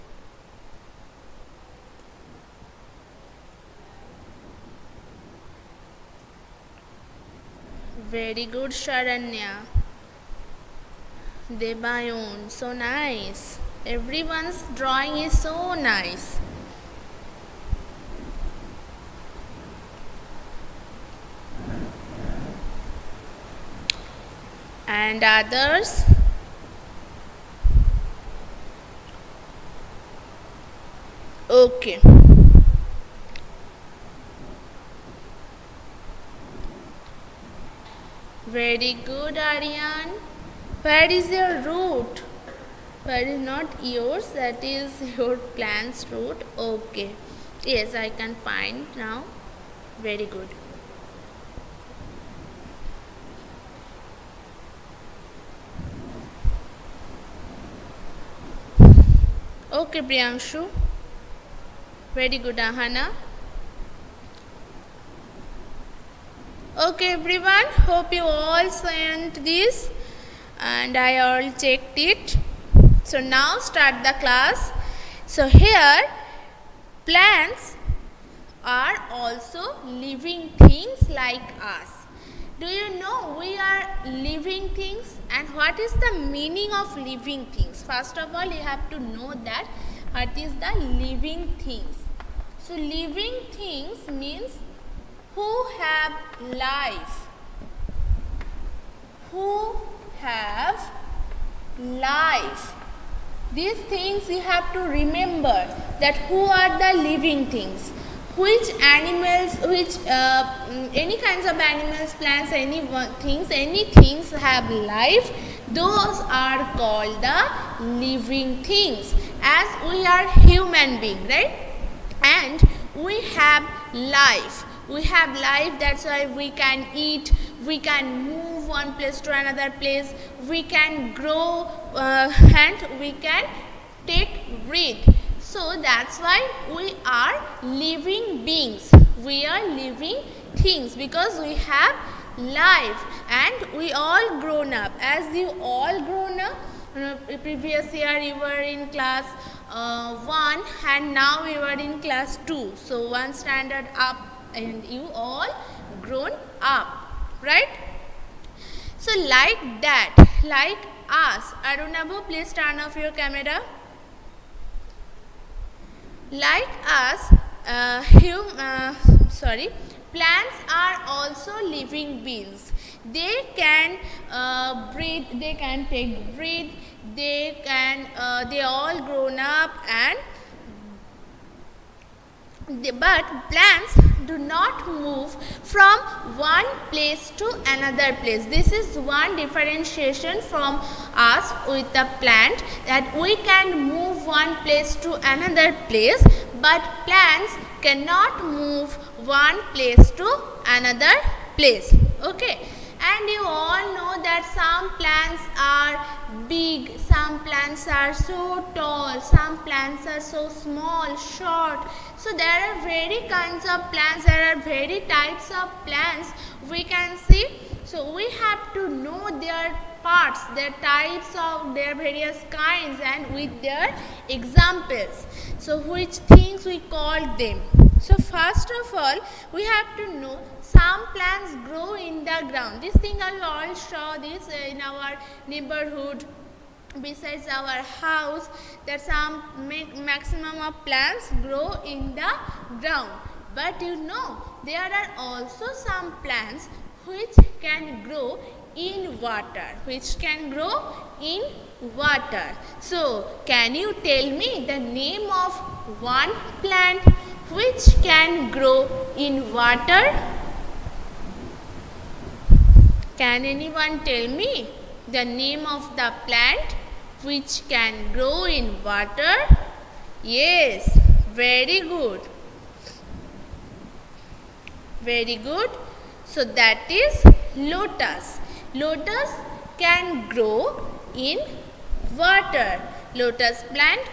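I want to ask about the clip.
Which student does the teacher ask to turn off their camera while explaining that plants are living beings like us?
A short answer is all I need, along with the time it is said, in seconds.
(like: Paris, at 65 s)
Arunabu, at 161 s.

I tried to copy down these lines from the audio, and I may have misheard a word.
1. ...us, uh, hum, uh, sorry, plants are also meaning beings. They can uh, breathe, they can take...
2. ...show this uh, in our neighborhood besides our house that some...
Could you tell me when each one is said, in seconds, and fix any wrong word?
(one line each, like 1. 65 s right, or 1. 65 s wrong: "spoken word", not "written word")
1. 166 s wrong: "living", not "meaning"
2. 233 s right.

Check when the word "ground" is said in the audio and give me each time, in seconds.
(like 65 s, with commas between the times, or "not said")
232 s, 242 s.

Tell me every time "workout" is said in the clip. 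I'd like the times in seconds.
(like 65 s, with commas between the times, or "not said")
not said.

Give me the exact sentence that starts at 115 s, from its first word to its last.
Those are called the living things as we are human being, right?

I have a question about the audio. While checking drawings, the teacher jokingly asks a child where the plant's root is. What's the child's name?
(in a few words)
Aryan.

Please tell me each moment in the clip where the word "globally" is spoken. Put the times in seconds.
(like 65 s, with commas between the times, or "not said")
not said.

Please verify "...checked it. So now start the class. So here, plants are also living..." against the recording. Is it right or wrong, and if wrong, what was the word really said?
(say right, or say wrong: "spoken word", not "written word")
right.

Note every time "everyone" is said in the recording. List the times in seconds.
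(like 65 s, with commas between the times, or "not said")
13 s, 67 s.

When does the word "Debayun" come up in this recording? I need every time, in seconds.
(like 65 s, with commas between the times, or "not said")
11 s.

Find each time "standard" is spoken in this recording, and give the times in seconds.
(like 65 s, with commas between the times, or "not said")
153 s.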